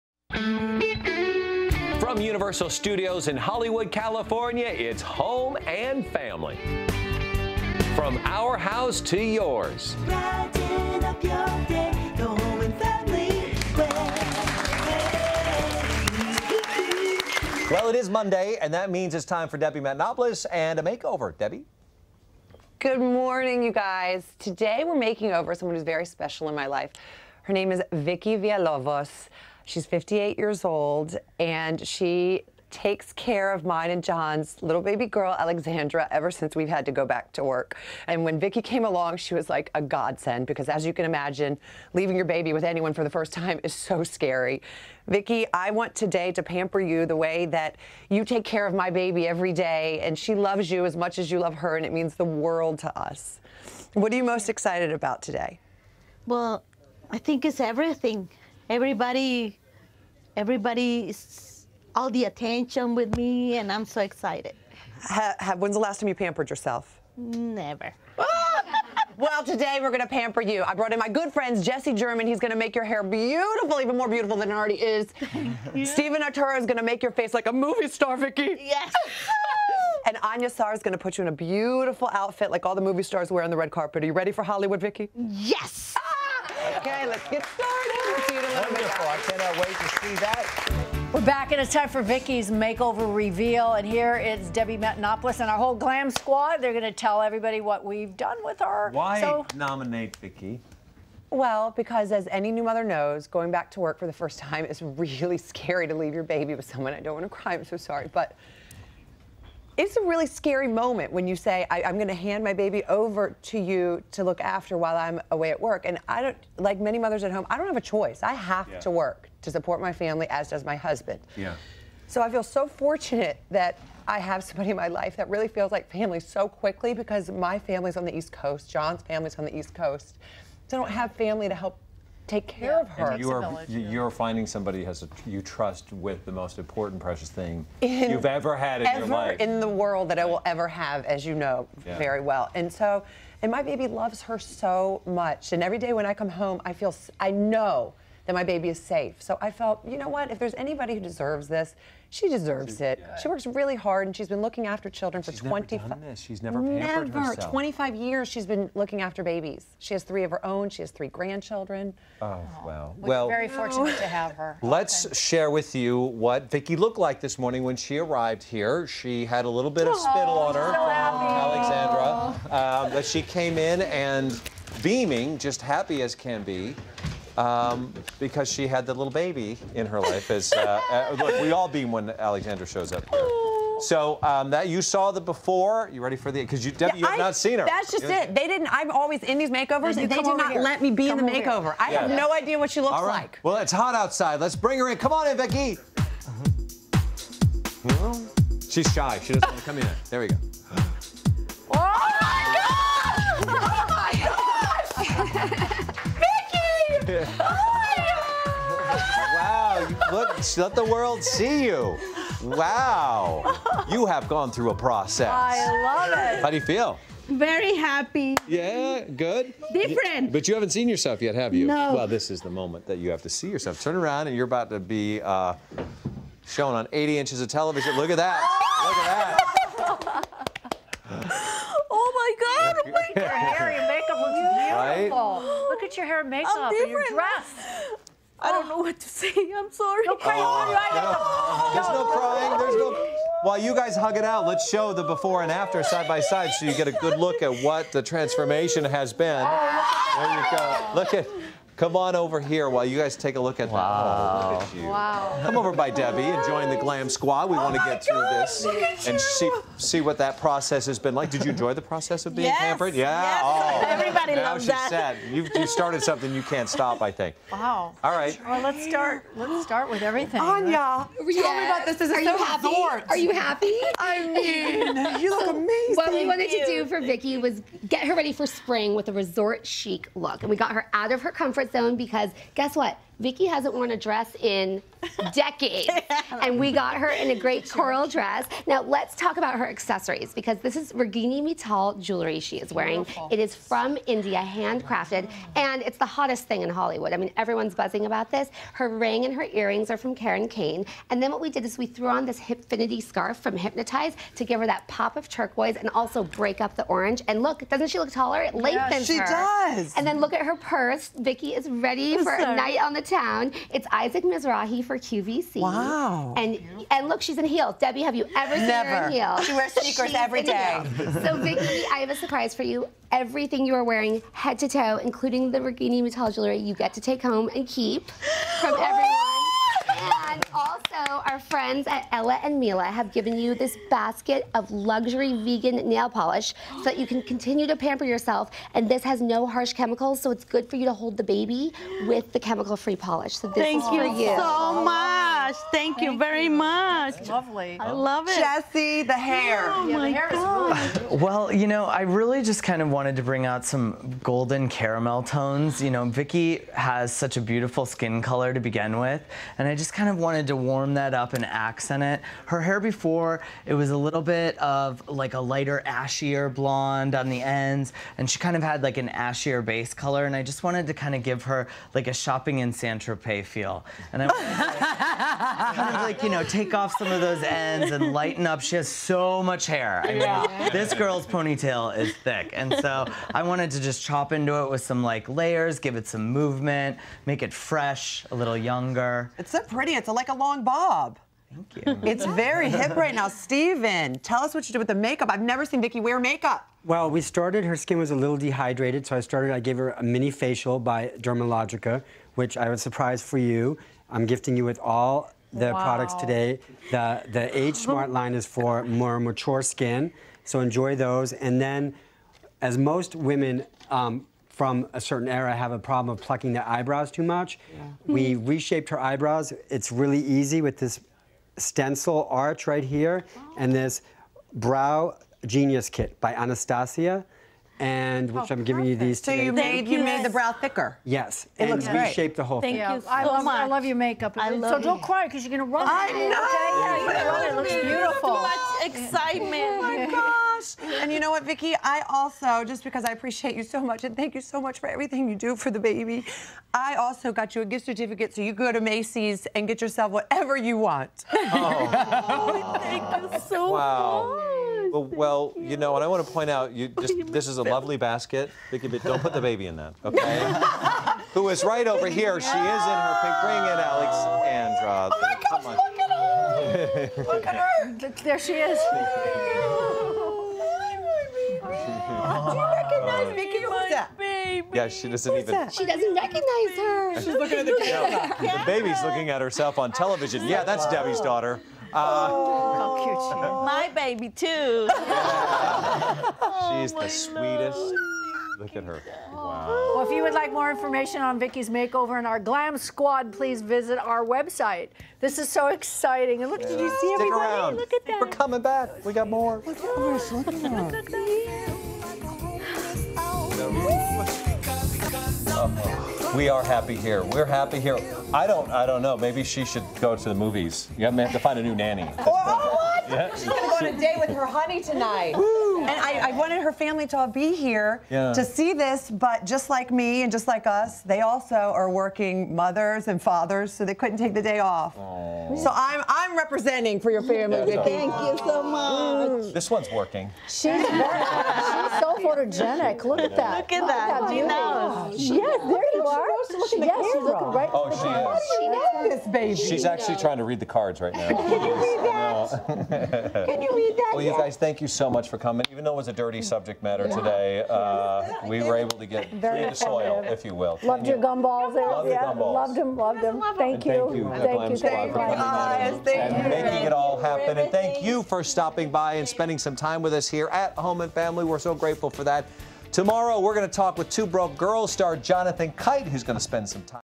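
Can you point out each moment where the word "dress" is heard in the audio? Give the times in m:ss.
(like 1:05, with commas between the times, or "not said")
3:57, 4:43, 4:48.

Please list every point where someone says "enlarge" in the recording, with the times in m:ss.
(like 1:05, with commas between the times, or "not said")
not said.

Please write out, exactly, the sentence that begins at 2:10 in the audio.
So I don't have family to help take care yeah, of her.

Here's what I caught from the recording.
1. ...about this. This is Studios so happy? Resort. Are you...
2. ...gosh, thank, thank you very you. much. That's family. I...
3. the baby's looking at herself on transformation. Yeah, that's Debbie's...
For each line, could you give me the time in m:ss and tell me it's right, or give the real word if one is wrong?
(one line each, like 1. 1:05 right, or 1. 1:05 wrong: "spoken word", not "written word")
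1. 4:31 wrong: "Are", not "Studios"
2. 5:45 wrong: "lovely", not "family"
3. 7:58 wrong: "television", not "transformation".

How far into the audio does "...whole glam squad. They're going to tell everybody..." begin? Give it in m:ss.
1:35.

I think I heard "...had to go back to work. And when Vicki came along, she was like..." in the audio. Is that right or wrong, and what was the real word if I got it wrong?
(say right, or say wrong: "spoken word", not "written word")
right.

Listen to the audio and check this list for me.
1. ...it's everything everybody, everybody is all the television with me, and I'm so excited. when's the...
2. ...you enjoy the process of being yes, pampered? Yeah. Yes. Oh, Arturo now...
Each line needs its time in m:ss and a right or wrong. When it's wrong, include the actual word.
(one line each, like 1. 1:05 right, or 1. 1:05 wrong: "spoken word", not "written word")
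1. 0:57 wrong: "attention", not "television"
2. 4:21 wrong: "Everybody", not "Arturo".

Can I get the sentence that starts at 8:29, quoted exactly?
Maybe she should go to the movies.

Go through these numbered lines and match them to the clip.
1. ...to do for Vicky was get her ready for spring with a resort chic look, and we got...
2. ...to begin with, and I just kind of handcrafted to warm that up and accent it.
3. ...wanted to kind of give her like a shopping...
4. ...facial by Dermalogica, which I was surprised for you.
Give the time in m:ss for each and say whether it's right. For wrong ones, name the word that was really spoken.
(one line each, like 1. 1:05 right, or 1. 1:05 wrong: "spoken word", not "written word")
1. 4:36 right
2. 5:58 wrong: "wanted", not "handcrafted"
3. 6:10 right
4. 6:40 right.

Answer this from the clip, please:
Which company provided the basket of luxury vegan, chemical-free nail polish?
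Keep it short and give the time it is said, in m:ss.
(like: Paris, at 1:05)
Ella and Mila, at 5:32.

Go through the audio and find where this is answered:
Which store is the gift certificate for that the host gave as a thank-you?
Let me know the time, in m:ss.
7:28.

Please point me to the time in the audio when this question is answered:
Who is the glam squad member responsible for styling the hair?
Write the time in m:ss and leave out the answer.
1:11.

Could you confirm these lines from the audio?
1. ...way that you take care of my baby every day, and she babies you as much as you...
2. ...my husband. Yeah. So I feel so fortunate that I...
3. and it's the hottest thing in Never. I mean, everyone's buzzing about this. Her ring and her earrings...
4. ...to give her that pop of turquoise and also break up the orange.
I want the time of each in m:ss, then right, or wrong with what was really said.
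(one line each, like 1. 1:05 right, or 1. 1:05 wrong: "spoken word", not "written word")
1. 0:47 wrong: "loves", not "babies"
2. 2:00 right
3. 4:55 wrong: "Hollywood", not "Never"
4. 5:04 right.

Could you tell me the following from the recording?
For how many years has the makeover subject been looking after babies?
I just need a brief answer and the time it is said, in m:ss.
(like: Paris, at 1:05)
25, at 2:37.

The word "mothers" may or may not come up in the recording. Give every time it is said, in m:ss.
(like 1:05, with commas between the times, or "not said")
1:42, 1:56, 8:42.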